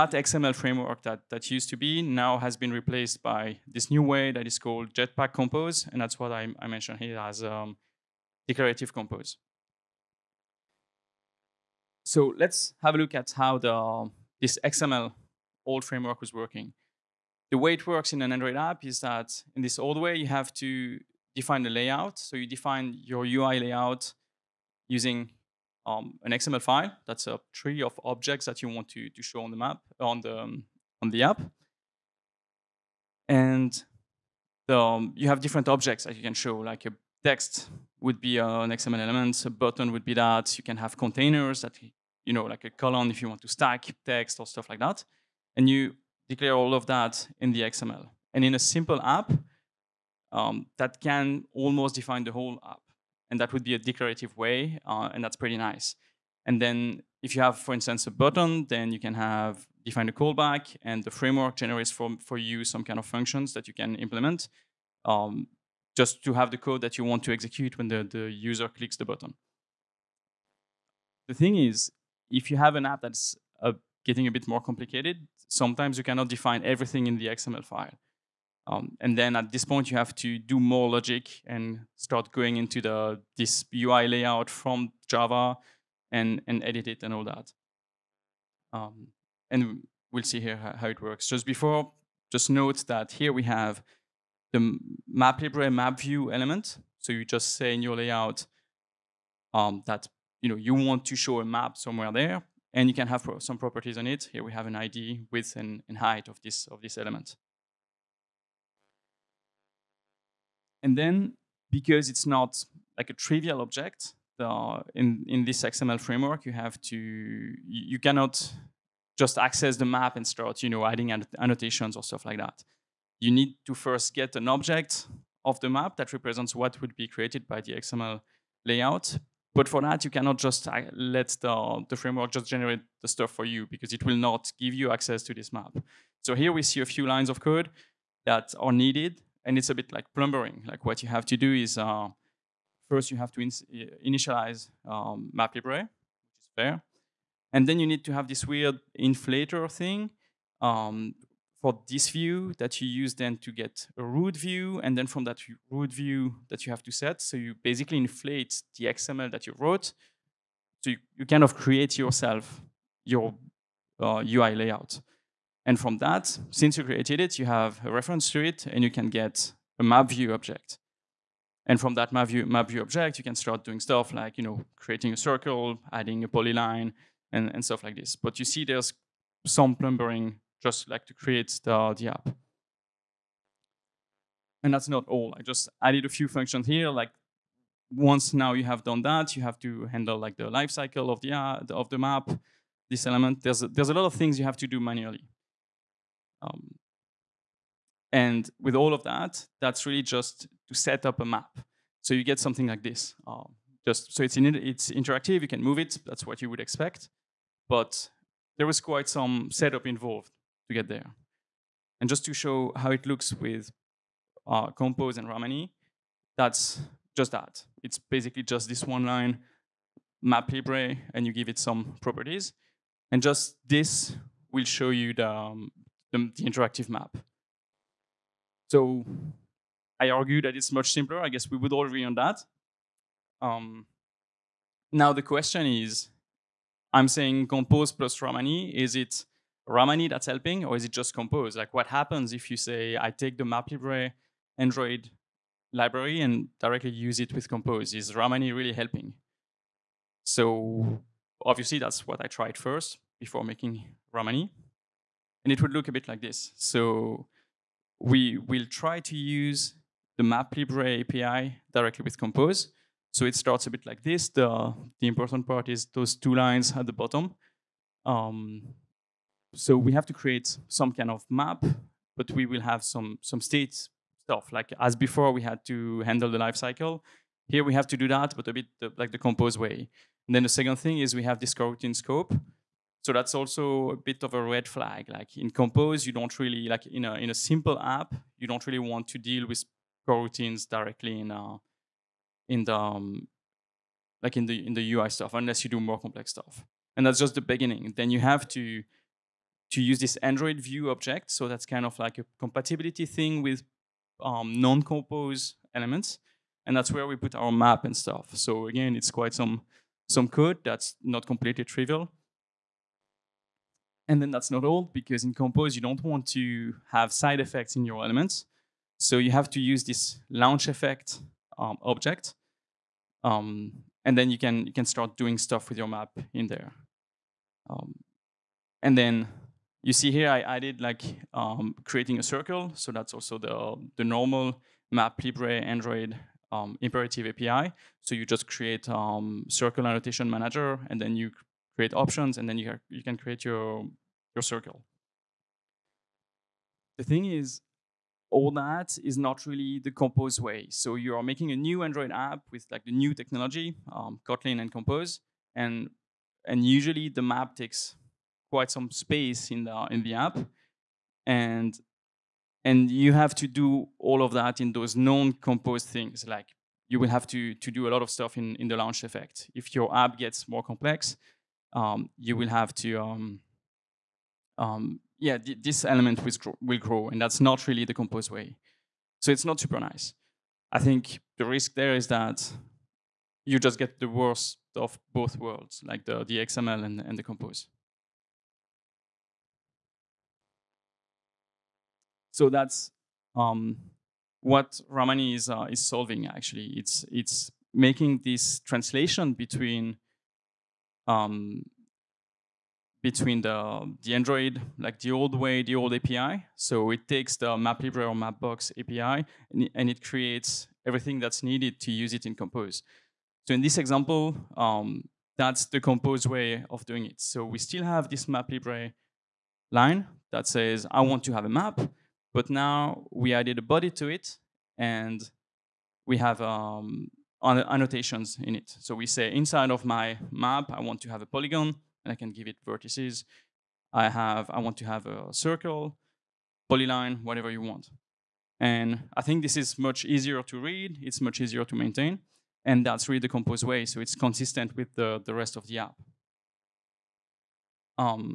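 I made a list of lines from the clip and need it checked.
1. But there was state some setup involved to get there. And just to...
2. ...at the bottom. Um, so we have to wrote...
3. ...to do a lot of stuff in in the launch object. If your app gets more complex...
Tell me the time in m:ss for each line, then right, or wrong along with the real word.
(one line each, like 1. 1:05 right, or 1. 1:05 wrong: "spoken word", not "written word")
1. 3:27 wrong: "quite", not "state"
2. 4:26 wrong: "create", not "wrote"
3. 6:07 wrong: "effect", not "object".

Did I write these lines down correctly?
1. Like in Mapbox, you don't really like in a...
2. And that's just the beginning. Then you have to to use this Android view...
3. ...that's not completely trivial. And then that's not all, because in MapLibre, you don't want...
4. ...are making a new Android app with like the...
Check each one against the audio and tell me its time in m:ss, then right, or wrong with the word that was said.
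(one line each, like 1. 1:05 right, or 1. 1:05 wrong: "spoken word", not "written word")
1. 4:45 wrong: "Compose", not "Mapbox"
2. 4:56 right
3. 5:10 wrong: "Compose", not "MapLibre"
4. 5:51 right.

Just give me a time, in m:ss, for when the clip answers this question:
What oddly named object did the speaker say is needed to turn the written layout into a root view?
2:28.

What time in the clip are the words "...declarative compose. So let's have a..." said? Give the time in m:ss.
0:08.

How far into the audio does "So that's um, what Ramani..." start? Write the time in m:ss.
6:32.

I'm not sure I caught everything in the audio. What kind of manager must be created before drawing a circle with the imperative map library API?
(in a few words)
circle annotation manager.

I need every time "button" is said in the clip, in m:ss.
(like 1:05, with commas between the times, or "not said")
0:39, 0:58, 1:09.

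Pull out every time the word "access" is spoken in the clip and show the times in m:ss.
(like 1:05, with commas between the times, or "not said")
1:59, 2:14.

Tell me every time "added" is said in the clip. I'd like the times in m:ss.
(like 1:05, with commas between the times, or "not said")
3:05, 5:30, 7:03.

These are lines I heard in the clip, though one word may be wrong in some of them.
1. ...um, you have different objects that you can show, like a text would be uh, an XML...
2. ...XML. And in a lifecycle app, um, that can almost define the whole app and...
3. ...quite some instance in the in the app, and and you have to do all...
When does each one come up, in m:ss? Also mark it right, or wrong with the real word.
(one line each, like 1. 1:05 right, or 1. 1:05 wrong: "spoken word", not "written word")
1. 0:34 right
2. 0:47 wrong: "simple", not "lifecycle"
3. 5:58 wrong: "space", not "instance".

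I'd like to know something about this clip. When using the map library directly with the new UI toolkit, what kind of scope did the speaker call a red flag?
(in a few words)
coroutine scope.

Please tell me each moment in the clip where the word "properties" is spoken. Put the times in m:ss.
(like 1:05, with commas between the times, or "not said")
1:43, 3:42.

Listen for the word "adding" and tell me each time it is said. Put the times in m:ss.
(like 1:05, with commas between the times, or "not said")
2:00, 2:55.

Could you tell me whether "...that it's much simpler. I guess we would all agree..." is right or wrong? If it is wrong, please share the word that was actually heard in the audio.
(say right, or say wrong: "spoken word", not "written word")
right.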